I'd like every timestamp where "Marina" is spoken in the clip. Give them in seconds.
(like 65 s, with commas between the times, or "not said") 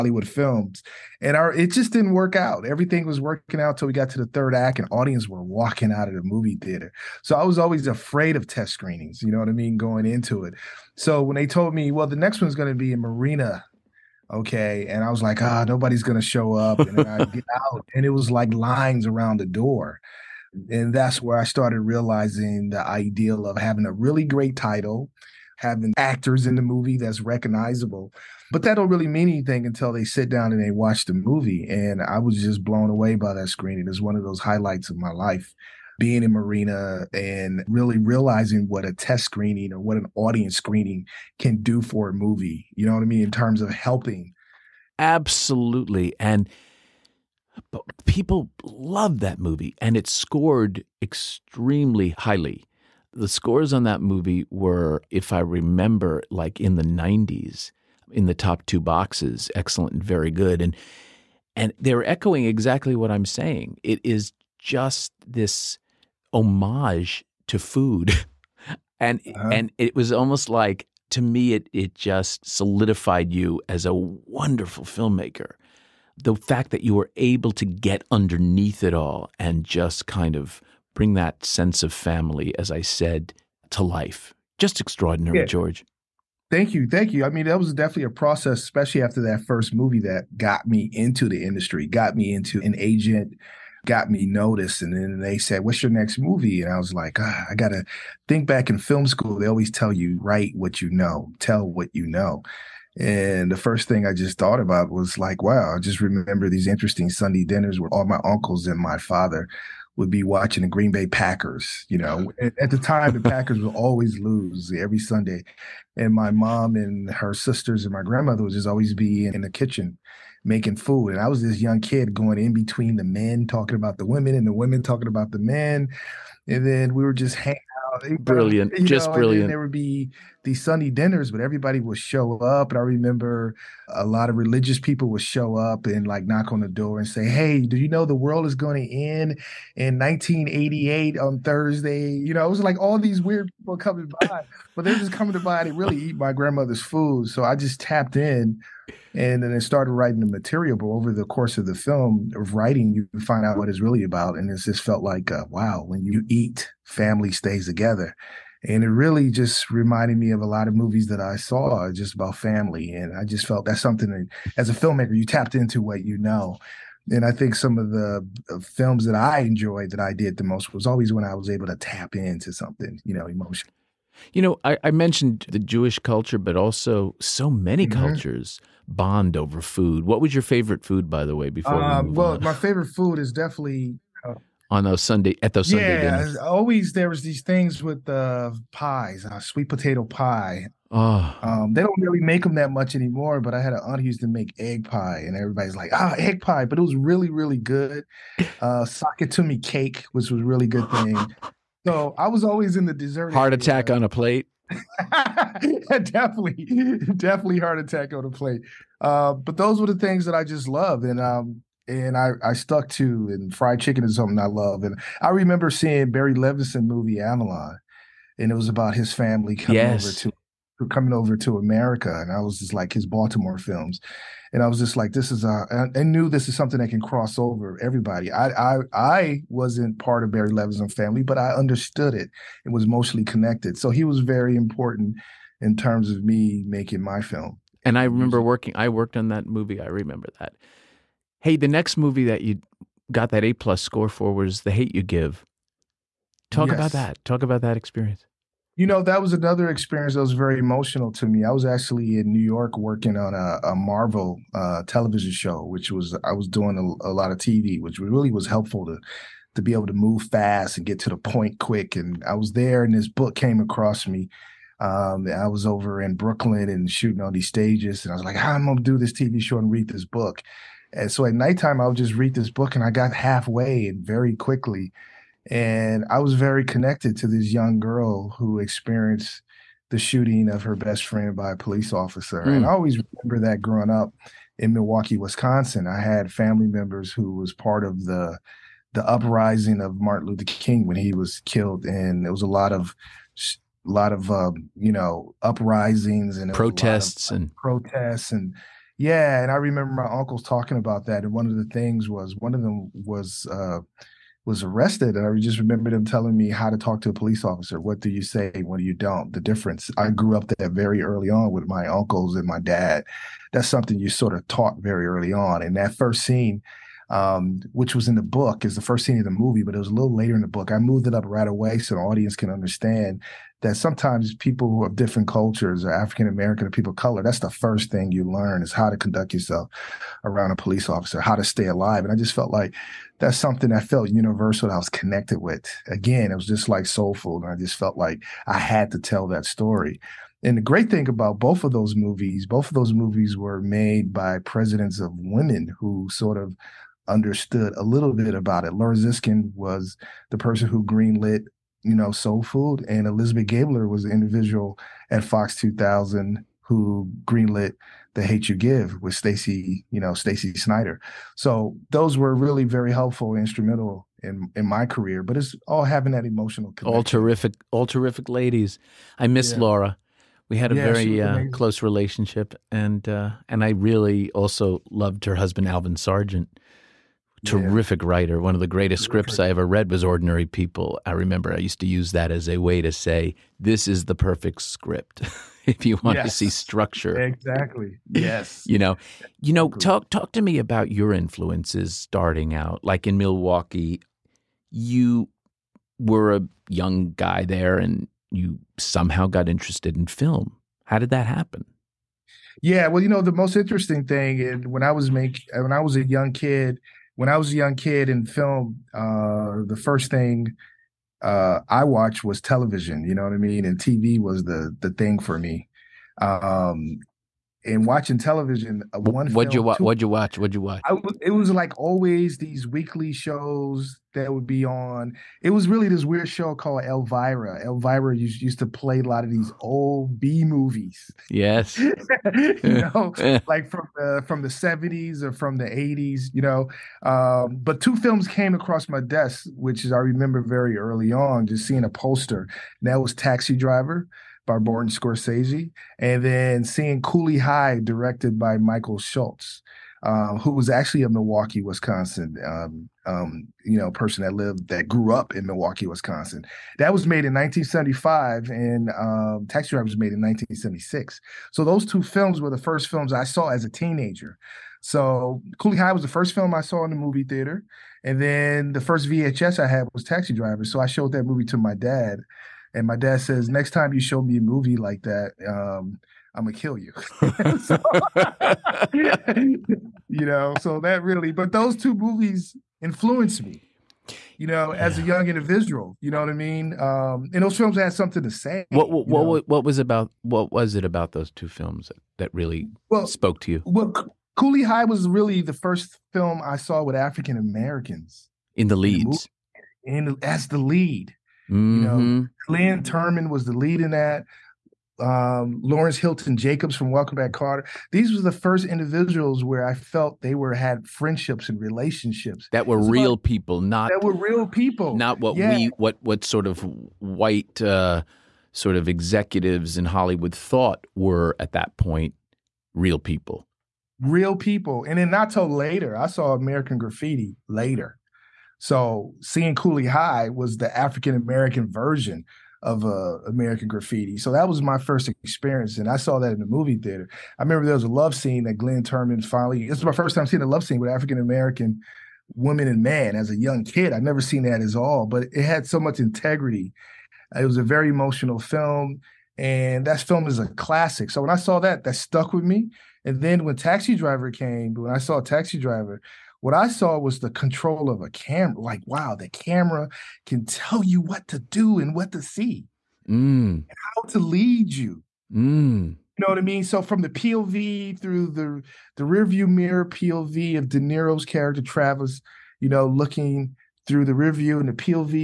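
13 s, 36 s.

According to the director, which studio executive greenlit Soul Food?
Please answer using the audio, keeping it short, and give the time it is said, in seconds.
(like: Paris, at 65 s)
Laura Ziskin, at 348 s.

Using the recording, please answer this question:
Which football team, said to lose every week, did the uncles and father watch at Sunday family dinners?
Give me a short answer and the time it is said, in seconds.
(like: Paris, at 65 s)
Green Bay Packers, at 110 s.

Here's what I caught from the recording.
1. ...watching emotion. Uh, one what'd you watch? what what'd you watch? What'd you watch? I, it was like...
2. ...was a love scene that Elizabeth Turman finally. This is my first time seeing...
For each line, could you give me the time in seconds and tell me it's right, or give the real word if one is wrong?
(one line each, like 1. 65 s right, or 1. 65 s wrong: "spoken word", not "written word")
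1. 417 s wrong: "television", not "emotion"
2. 537 s wrong: "Glynn", not "Elizabeth".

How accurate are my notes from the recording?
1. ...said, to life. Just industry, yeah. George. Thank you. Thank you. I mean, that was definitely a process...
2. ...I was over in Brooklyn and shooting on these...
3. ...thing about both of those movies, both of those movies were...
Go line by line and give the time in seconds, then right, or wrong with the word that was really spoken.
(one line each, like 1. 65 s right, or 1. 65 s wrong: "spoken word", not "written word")
1. 82 s wrong: "extraordinary", not "industry"
2. 265 s right
3. 340 s right.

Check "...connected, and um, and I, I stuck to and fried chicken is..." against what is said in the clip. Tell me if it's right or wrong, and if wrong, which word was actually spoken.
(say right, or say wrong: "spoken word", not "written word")
wrong: "loved", not "connected".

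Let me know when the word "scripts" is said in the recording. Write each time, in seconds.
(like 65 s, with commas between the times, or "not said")
379 s, 384 s.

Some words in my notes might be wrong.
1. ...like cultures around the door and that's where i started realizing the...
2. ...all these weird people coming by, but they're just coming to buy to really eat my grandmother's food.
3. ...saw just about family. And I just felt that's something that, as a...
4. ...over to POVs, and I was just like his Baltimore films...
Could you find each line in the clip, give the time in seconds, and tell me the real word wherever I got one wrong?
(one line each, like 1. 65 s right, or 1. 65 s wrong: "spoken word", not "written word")
1. 18 s wrong: "lines", not "cultures"
2. 142 s right
3. 161 s right
4. 221 s wrong: "America", not "POVs".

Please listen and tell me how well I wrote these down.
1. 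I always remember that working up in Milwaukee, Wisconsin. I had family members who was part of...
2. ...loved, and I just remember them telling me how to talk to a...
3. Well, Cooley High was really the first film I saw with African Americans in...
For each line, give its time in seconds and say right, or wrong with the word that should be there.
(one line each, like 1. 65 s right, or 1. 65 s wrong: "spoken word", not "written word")
1. 282 s wrong: "growing", not "working"
2. 304 s wrong: "arrested", not "loved"
3. 493 s right.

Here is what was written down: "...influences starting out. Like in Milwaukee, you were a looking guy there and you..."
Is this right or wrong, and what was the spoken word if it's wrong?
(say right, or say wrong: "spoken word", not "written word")
wrong: "young", not "looking".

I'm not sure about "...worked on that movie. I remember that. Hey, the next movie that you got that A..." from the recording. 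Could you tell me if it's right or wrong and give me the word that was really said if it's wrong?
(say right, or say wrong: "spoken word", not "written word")
right.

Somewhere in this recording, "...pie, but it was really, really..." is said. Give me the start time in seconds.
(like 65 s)
196 s.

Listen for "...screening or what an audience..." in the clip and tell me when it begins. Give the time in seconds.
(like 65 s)
39 s.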